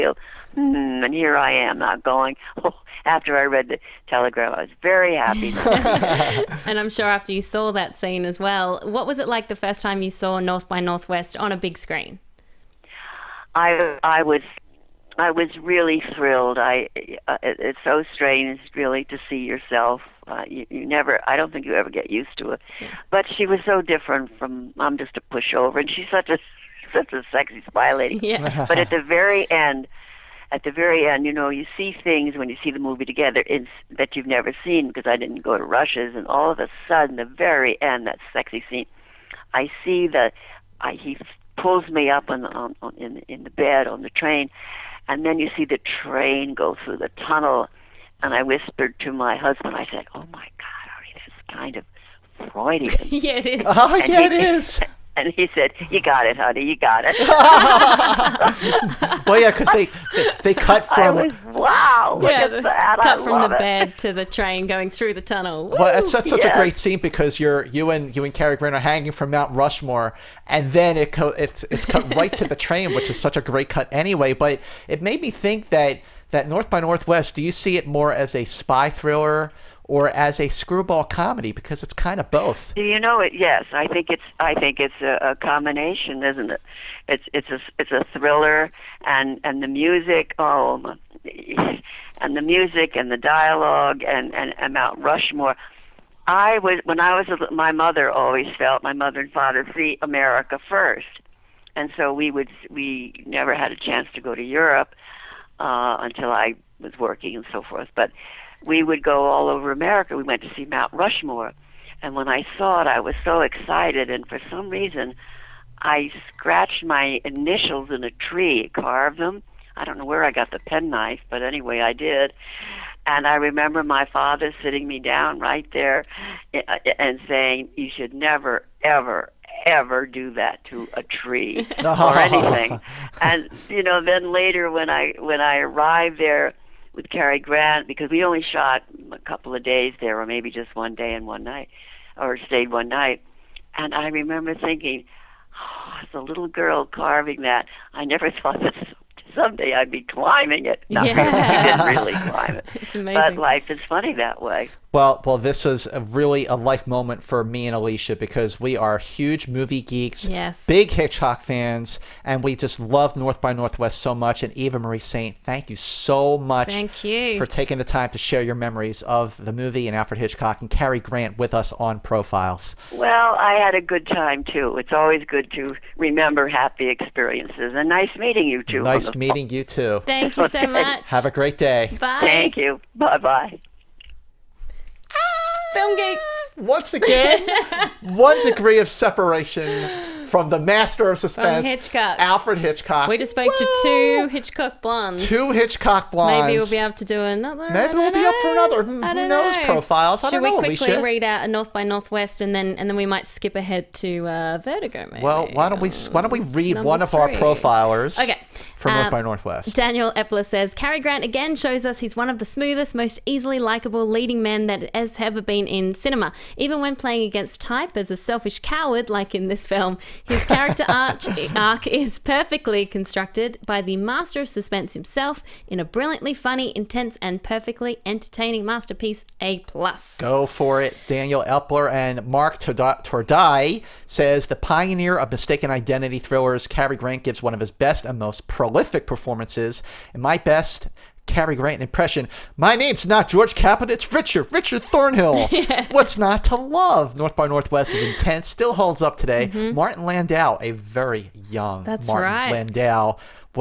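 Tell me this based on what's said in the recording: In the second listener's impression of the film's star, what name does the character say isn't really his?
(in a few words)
George Caput.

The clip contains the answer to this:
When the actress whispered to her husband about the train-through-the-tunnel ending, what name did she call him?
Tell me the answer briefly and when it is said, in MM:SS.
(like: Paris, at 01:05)
Artie, at 00:50.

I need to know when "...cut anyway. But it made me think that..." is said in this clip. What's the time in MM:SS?
01:13.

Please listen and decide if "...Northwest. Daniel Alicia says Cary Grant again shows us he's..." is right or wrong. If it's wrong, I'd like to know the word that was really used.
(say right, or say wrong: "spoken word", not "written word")
wrong: "Epler", not "Alicia".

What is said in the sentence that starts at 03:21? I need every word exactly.
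read out a North by Northwest and then and then we might skip ahead to uh, Vertigo?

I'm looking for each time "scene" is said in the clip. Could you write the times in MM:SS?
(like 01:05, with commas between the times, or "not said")
00:07, 00:38, 01:06.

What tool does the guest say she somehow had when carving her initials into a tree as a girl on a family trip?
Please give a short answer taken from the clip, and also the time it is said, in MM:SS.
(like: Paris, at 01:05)
penknife, at 02:00.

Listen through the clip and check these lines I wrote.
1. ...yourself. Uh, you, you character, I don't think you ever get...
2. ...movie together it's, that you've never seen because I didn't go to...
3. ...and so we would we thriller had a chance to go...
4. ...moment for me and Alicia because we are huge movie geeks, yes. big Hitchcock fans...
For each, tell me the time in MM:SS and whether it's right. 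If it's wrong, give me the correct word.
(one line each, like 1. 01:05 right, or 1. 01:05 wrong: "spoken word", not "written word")
1. 00:19 wrong: "never", not "character"
2. 00:32 right
3. 01:41 wrong: "never", not "thriller"
4. 02:36 right.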